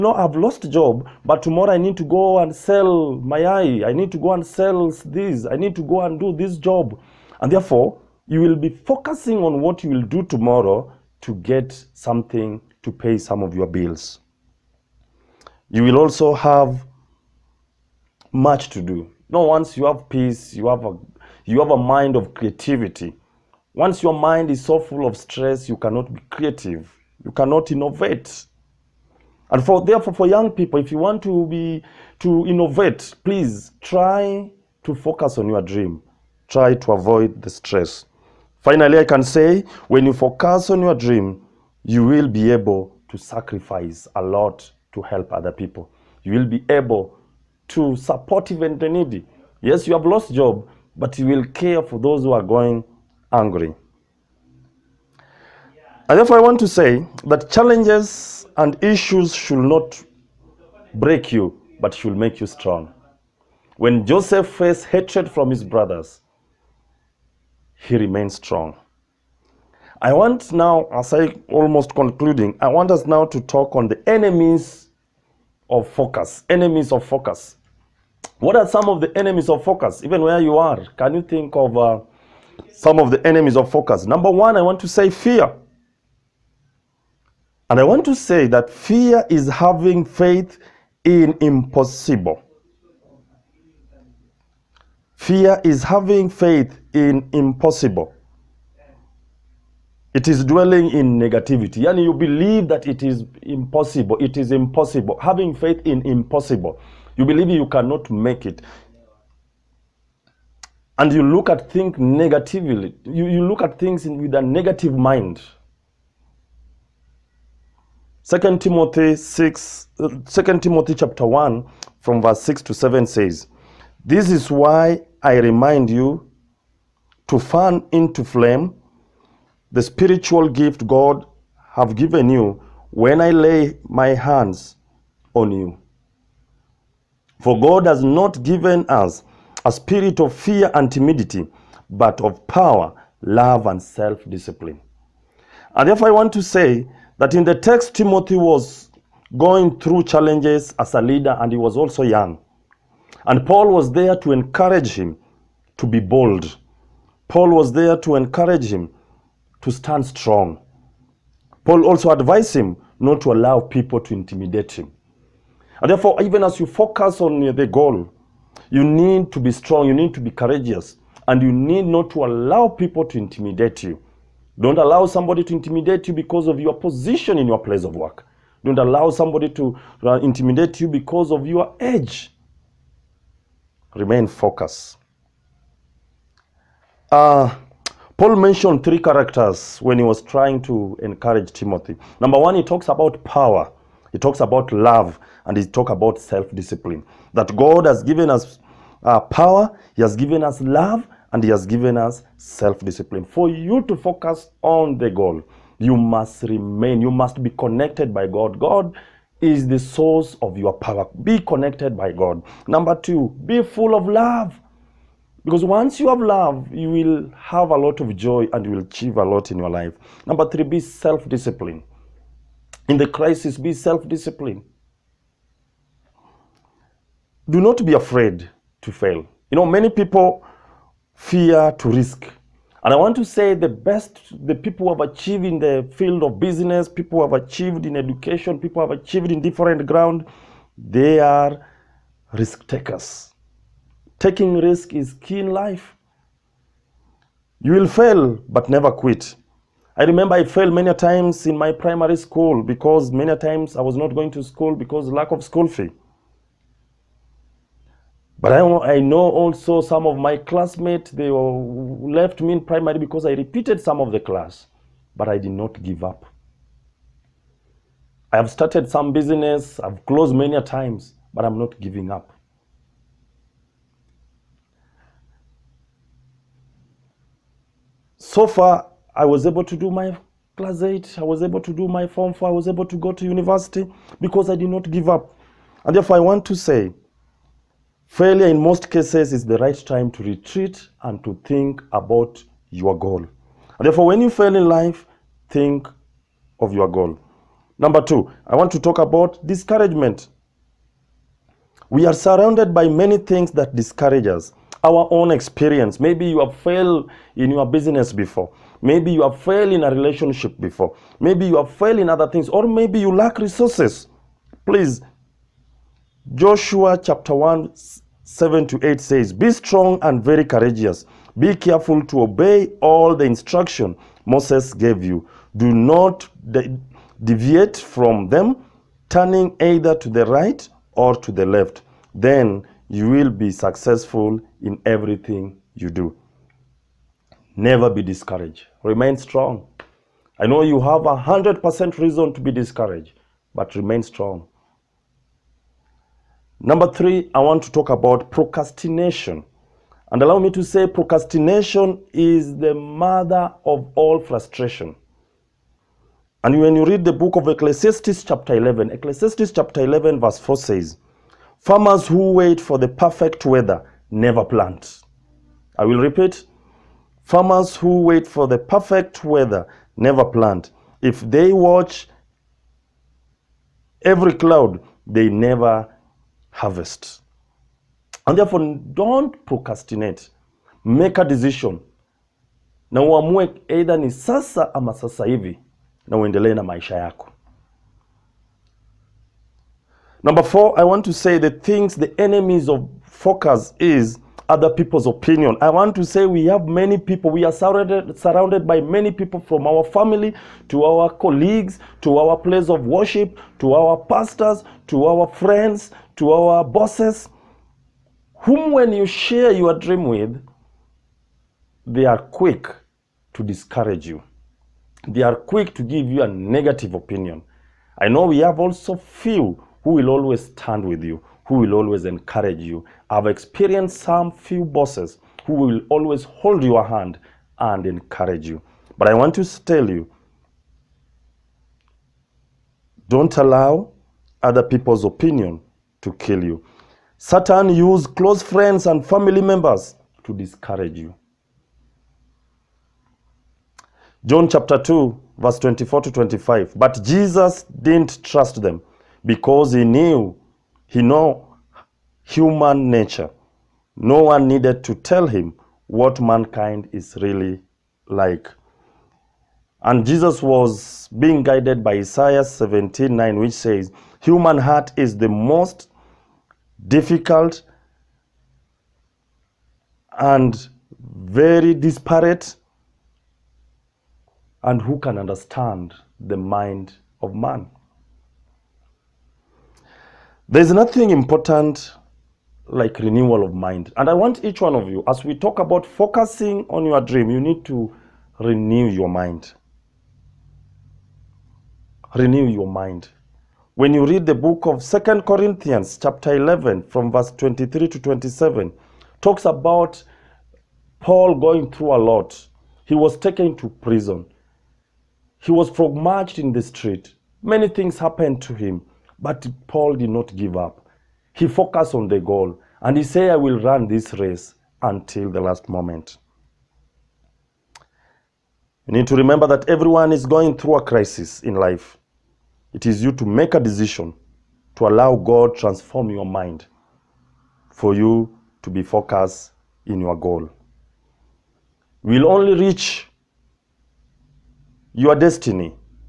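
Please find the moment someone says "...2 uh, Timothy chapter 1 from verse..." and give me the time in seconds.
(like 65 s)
119 s.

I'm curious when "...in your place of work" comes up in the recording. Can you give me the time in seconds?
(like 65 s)
177 s.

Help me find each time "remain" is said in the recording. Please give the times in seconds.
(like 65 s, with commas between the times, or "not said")
67 s, 183 s, 206 s, 338 s, 343 s.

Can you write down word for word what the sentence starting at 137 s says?
For God has not given us a spirit of fear and timidity, but of power, love, and self-discipline.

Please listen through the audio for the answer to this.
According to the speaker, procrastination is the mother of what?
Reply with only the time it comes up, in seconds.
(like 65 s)
353 s.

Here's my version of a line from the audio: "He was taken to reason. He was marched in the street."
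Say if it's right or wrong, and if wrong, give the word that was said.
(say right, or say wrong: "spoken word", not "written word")
wrong: "prison", not "reason".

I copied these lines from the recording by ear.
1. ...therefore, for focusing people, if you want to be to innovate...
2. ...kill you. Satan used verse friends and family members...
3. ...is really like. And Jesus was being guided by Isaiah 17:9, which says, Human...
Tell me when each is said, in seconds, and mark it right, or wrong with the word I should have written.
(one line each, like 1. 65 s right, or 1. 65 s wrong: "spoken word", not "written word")
1. 29 s wrong: "young", not "focusing"
2. 436 s wrong: "close", not "verse"
3. 456 s right.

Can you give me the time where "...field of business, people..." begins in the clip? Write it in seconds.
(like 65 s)
235 s.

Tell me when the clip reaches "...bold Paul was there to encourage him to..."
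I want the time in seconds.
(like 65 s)
155 s.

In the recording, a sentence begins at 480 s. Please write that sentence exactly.
There's nothing important like renewal of mind.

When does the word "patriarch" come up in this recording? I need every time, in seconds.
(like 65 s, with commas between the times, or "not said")
not said.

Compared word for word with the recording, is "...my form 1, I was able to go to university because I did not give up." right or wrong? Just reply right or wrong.
wrong.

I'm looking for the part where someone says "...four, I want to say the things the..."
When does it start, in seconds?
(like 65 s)
390 s.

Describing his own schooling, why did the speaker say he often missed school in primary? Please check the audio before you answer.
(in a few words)
lack of school fee.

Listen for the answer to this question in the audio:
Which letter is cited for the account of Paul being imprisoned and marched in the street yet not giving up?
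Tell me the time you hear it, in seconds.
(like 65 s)
494 s.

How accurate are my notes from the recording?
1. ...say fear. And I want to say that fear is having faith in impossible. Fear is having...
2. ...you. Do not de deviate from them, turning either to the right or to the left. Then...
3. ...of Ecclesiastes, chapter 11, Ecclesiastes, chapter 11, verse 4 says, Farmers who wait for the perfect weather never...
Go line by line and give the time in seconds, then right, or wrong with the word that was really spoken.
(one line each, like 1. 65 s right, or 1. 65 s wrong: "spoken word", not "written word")
1. 84 s right
2. 325 s right
3. 357 s right.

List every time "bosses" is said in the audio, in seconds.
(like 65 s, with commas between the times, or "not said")
406 s, 424 s.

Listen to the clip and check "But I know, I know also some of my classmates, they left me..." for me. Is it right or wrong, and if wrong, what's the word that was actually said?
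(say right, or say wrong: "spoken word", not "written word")
right.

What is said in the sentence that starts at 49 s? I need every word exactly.
Yes, you have lost job, but you will care for those who are going hungry.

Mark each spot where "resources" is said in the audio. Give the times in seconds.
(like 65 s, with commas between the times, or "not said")
313 s.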